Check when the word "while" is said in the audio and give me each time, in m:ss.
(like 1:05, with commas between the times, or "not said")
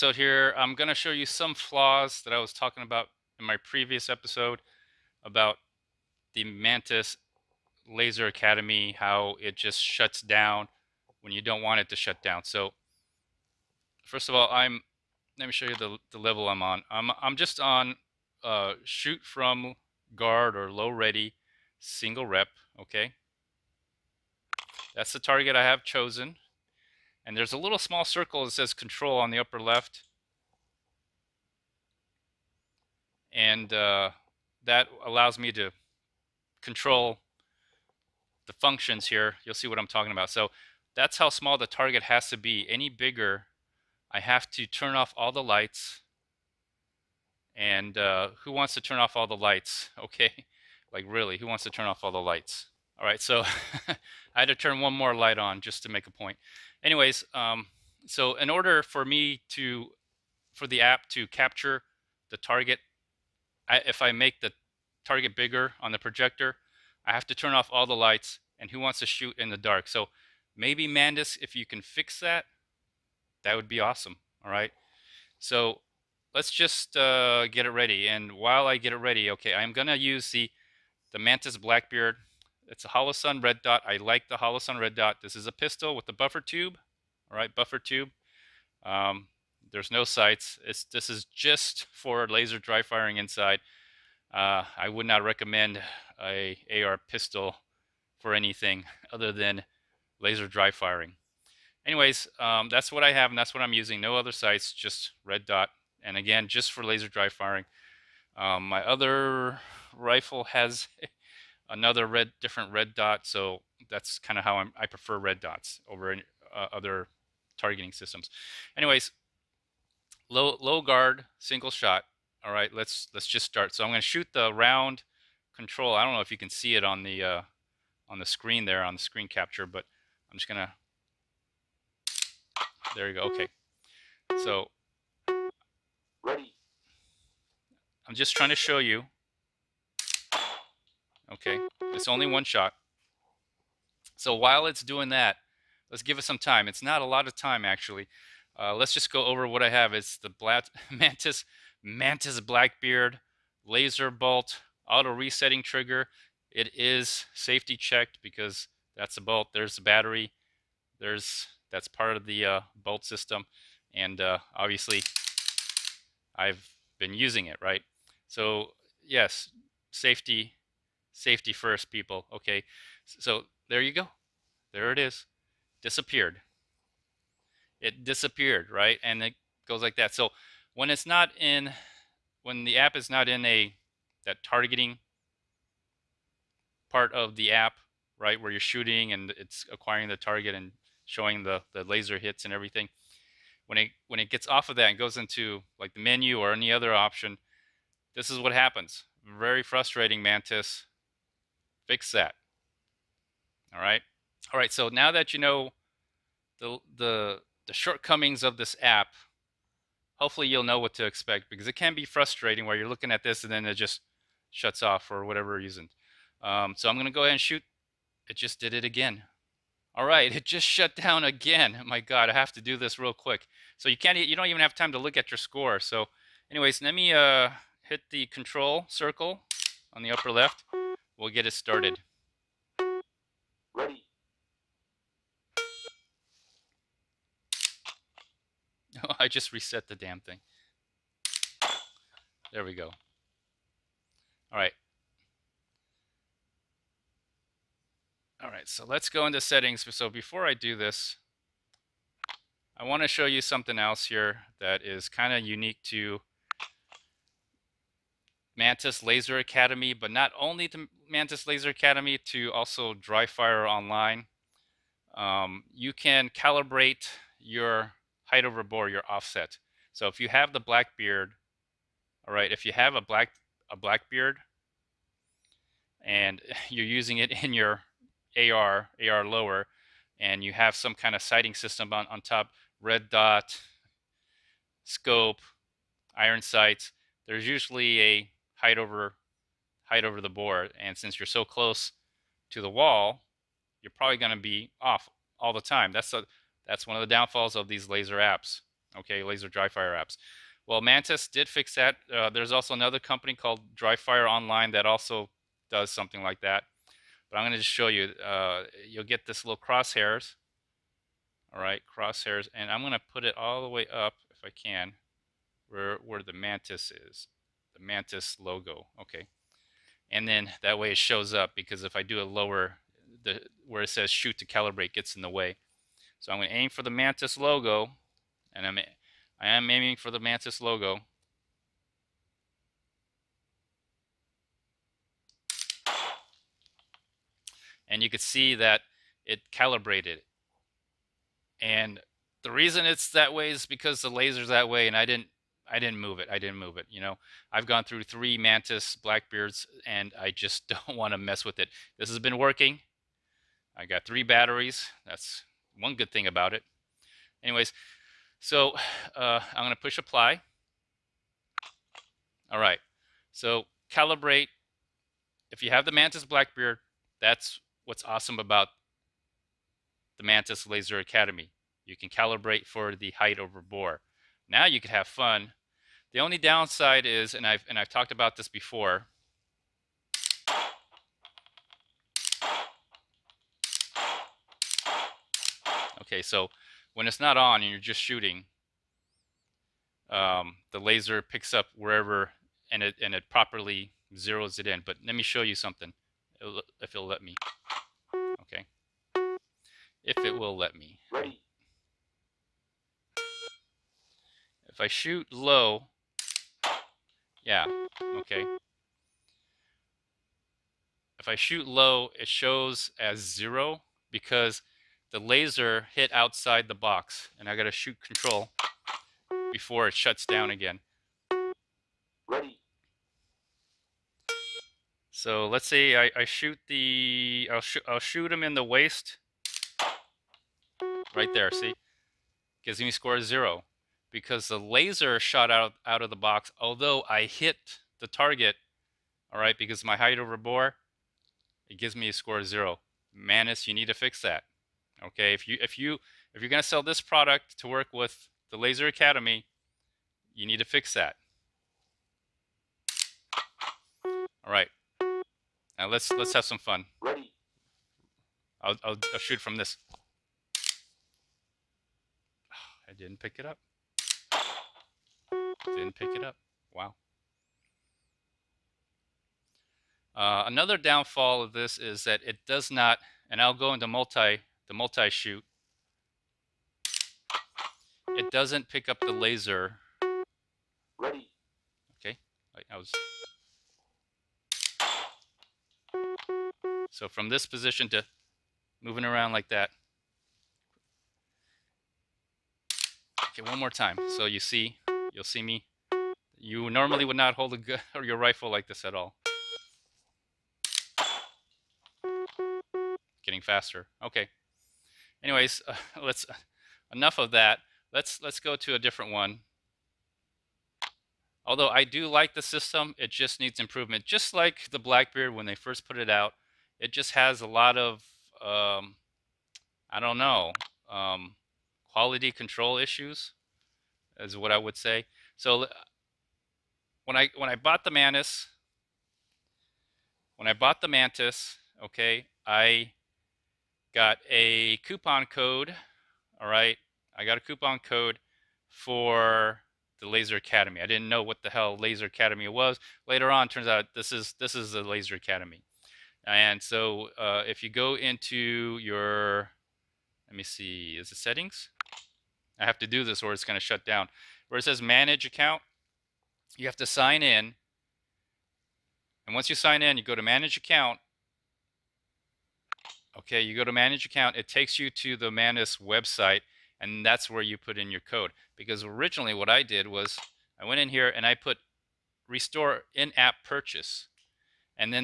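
1:18, 2:24.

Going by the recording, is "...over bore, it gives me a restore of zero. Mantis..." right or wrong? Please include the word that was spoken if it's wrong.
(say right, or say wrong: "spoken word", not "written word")
wrong: "score", not "restore".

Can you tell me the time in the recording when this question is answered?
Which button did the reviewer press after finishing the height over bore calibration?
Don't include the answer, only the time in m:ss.
5:59.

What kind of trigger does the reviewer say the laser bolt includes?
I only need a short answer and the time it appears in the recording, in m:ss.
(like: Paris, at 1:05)
Auto Resetting Trigger, at 2:34.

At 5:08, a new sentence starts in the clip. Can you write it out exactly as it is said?
Uh, you'll get this little crosshairs.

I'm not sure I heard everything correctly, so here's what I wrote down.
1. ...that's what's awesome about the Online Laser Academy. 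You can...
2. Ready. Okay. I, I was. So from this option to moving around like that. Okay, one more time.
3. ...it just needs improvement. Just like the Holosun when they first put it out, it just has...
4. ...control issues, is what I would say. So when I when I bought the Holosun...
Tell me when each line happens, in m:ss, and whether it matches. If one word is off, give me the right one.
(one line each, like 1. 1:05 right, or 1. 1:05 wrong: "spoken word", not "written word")
1. 6:07 wrong: "Mantis", not "Online"
2. 8:00 wrong: "position", not "option"
3. 8:32 wrong: "Blackbeard", not "Holosun"
4. 8:42 wrong: "Manus", not "Holosun".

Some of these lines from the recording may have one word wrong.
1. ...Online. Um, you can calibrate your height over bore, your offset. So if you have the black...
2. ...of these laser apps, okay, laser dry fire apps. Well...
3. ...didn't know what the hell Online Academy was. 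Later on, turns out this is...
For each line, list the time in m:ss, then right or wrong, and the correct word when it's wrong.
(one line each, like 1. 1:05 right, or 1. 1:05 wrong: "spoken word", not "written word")
1. 4:23 right
2. 4:57 right
3. 9:00 wrong: "Laser", not "Online".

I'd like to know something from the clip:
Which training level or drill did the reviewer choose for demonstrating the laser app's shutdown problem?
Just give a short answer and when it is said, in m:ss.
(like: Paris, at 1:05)
Shoot from guard or low ready, at 0:18.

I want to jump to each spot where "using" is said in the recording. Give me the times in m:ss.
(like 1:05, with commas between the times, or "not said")
1:43, 2:47, 4:36.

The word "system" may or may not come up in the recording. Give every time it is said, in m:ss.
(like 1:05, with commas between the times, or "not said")
1:57, 2:43, 4:41, 8:32.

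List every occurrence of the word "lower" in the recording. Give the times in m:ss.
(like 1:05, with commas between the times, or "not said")
4:39, 5:22.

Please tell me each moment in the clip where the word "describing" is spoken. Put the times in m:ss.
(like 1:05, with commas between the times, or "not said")
not said.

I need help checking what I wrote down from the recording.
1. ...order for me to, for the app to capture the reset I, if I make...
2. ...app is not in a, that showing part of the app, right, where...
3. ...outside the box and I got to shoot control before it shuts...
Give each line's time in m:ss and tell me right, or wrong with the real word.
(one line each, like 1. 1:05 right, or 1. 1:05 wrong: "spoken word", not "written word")
1. 0:58 wrong: "target", not "reset"
2. 3:02 wrong: "targeting", not "showing"
3. 6:56 right.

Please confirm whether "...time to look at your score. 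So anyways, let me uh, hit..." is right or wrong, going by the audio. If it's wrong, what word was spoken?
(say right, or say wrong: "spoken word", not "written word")
right.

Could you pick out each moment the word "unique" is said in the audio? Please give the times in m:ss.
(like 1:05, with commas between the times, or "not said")
4:15.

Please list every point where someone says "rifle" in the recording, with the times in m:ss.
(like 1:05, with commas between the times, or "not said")
1:49, 8:18.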